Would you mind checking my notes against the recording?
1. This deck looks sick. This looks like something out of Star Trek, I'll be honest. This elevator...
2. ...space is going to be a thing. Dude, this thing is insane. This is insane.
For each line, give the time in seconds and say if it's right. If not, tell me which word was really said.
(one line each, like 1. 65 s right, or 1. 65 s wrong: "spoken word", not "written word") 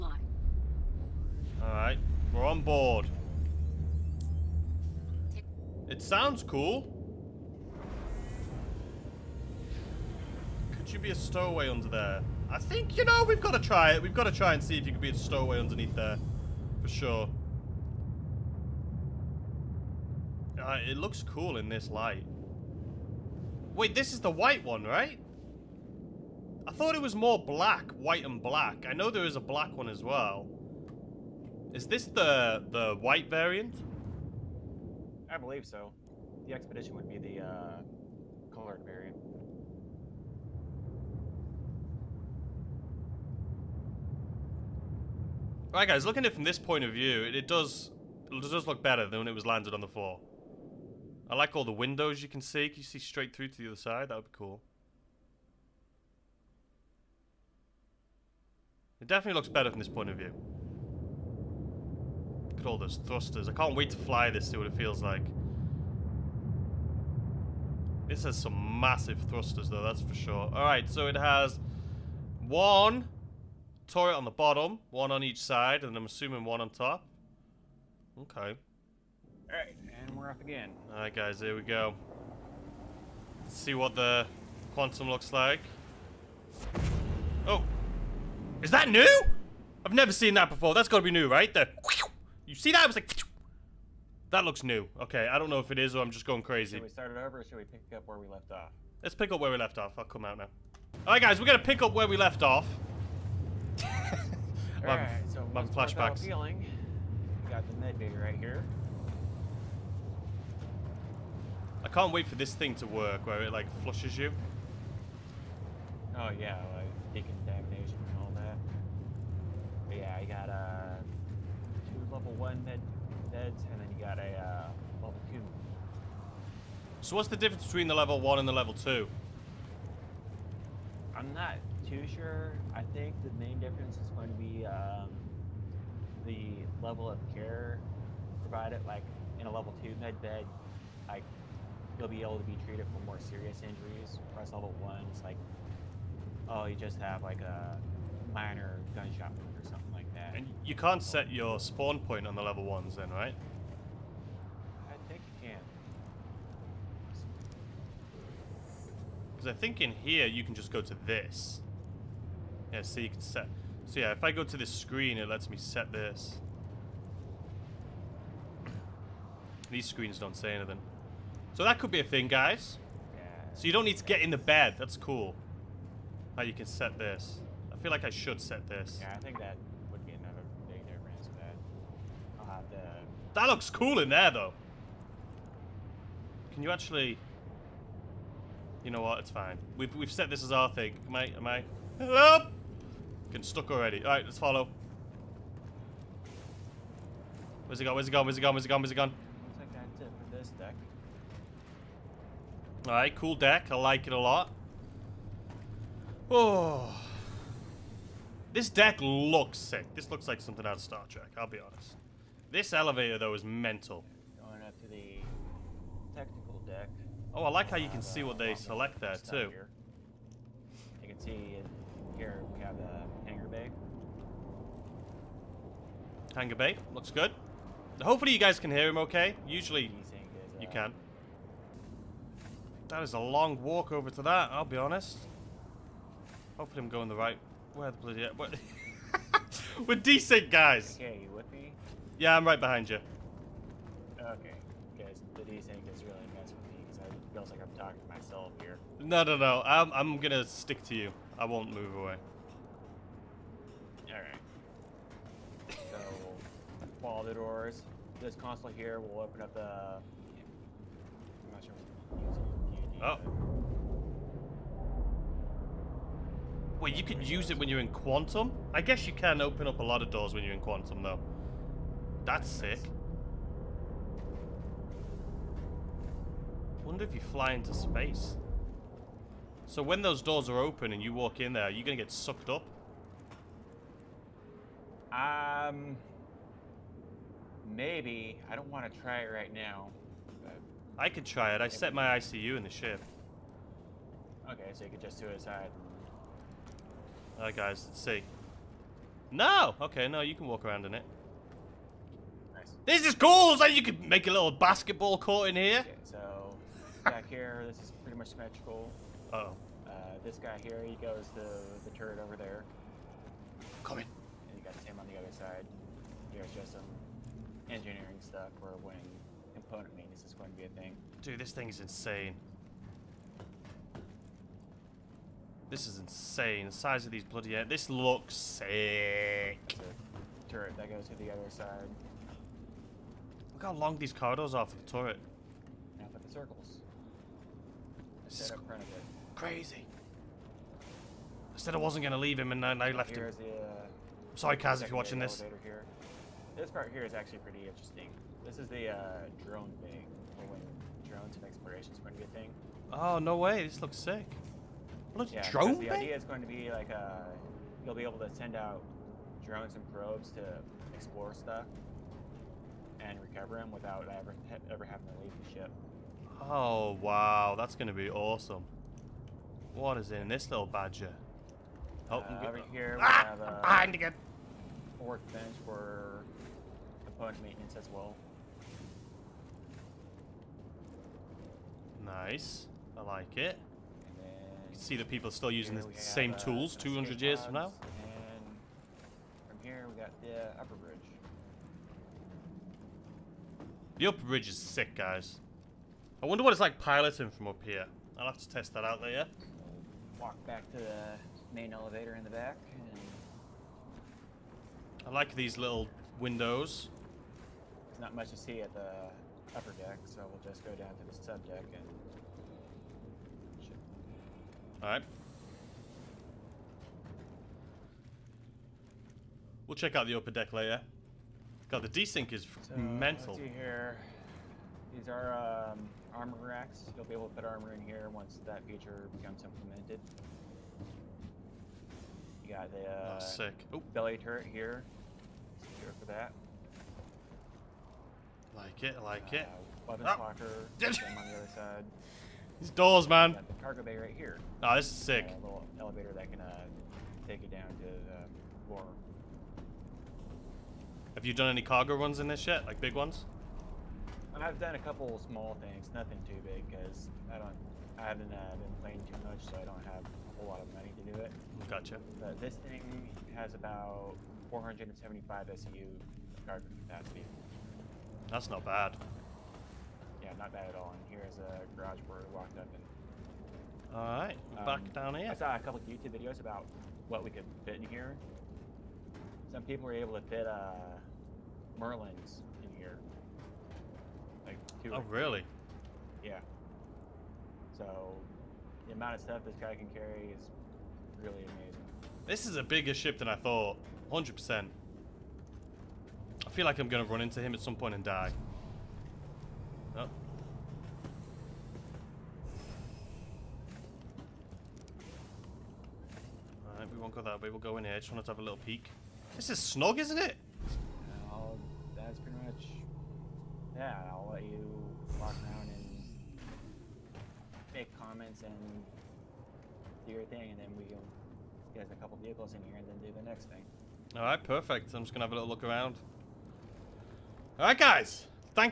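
1. 208 s right
2. 319 s wrong: "maintenance", not "space".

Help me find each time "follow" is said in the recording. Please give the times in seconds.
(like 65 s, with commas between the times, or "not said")
194 s, 257 s.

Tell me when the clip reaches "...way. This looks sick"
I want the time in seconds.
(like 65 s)
353 s.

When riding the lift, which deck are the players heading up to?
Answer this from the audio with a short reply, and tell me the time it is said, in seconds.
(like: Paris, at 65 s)
Technical deck, at 216 s.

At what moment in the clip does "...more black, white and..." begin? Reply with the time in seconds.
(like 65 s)
27 s.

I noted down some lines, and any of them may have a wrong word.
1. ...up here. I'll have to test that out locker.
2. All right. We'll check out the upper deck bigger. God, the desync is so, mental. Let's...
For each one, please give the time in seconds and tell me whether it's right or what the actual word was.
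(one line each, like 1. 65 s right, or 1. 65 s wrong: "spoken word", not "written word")
1. 397 s wrong: "later", not "locker"
2. 414 s wrong: "later", not "bigger".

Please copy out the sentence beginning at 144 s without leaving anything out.
Whereas level one like, oh, you just have like a minor gunshot wound or something like that.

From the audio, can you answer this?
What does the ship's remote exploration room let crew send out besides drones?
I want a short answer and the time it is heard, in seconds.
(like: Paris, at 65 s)
Probes, at 359 s.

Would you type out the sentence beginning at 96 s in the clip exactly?
Should we start it over or should we pick up where we left off?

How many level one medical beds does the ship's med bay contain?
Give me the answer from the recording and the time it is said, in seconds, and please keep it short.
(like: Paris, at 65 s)
2, at 121 s.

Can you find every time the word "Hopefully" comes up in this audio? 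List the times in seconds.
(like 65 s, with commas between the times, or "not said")
228 s, 236 s.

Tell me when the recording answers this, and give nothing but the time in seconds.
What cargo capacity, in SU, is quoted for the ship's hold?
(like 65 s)
464 s.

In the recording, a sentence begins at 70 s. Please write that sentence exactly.
Alright, so it has one, turret on the bottom, one on each side, and I'm assuming one on top.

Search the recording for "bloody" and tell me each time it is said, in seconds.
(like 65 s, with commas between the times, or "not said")
237 s, 327 s.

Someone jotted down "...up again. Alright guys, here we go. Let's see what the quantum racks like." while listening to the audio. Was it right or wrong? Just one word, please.
wrong.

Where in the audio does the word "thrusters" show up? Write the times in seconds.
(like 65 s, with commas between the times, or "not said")
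63 s, 69 s.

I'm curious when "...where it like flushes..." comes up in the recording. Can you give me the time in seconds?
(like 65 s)
113 s.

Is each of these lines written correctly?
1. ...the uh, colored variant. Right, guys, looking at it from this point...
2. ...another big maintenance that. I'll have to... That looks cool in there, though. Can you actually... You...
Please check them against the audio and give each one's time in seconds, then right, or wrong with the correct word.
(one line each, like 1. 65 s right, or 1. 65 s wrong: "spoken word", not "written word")
1. 37 s right
2. 180 s wrong: "difference", not "maintenance".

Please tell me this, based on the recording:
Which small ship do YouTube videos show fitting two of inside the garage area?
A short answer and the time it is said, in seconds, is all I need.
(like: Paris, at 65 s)
Merlins, at 481 s.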